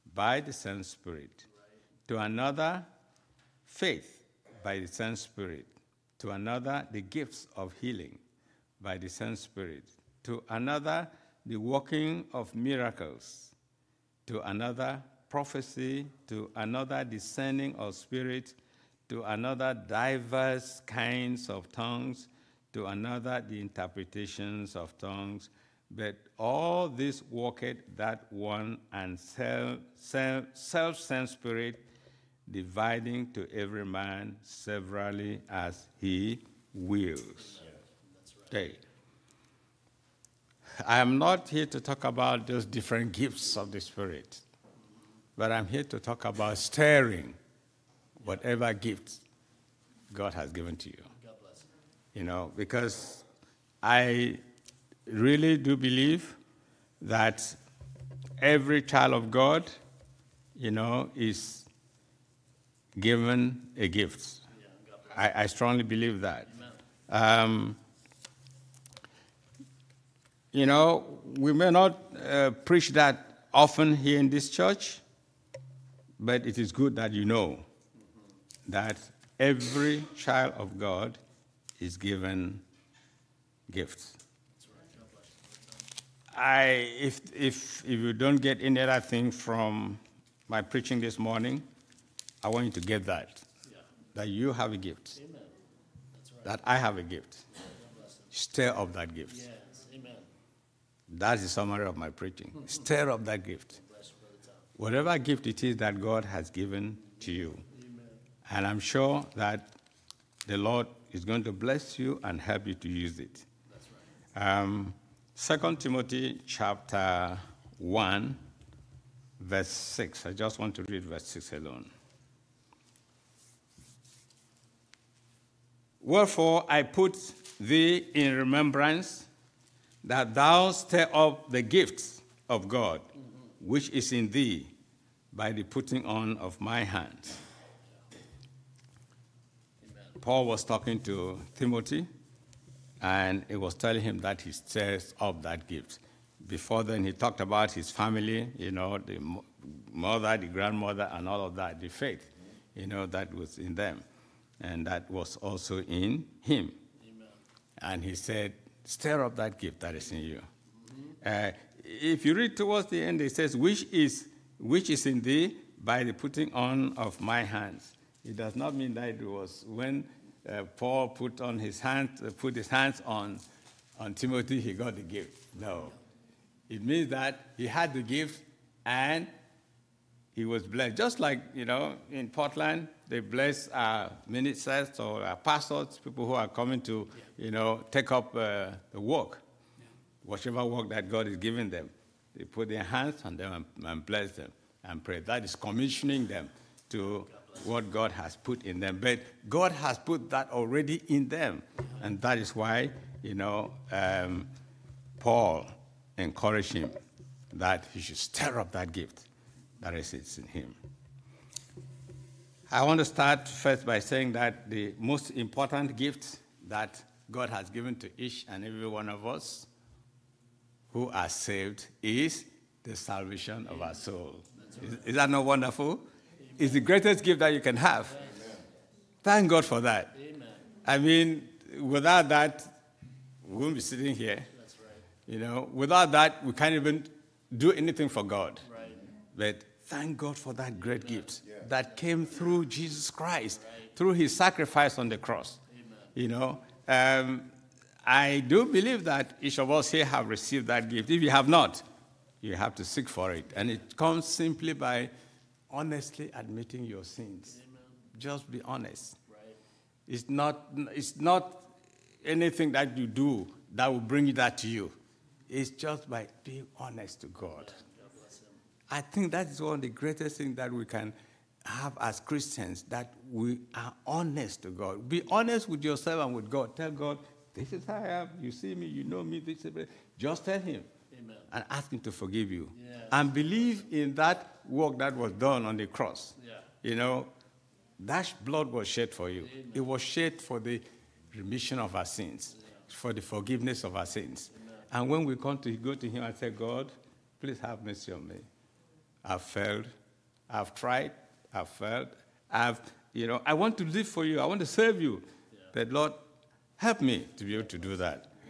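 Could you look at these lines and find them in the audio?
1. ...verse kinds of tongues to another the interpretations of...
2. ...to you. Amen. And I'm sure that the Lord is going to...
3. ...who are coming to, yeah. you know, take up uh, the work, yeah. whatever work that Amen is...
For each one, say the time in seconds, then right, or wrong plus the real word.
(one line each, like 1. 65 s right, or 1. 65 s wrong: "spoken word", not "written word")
1. 19 s wrong: "diverse", not "verse"
2. 107 s right
3. 186 s wrong: "God", not "Amen".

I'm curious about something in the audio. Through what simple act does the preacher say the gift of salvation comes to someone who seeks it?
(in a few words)
honestly admitting your sins.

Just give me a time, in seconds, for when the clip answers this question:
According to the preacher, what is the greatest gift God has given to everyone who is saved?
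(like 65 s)
222 s.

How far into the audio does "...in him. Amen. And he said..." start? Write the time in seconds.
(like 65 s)
155 s.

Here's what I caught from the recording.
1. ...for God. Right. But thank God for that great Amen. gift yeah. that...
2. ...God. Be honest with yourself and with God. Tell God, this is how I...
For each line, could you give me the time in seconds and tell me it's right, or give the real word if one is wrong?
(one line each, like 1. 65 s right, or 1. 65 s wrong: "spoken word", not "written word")
1. 238 s right
2. 274 s right.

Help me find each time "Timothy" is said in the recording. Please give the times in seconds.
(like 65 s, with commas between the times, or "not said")
115 s, 141 s, 174 s.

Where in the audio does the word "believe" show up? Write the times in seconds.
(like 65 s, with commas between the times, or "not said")
55 s, 65 s, 248 s, 283 s.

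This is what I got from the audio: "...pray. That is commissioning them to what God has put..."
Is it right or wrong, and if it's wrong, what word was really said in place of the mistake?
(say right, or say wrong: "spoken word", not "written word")
right.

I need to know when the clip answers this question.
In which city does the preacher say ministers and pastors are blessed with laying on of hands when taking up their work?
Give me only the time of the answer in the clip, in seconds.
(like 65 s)
182 s.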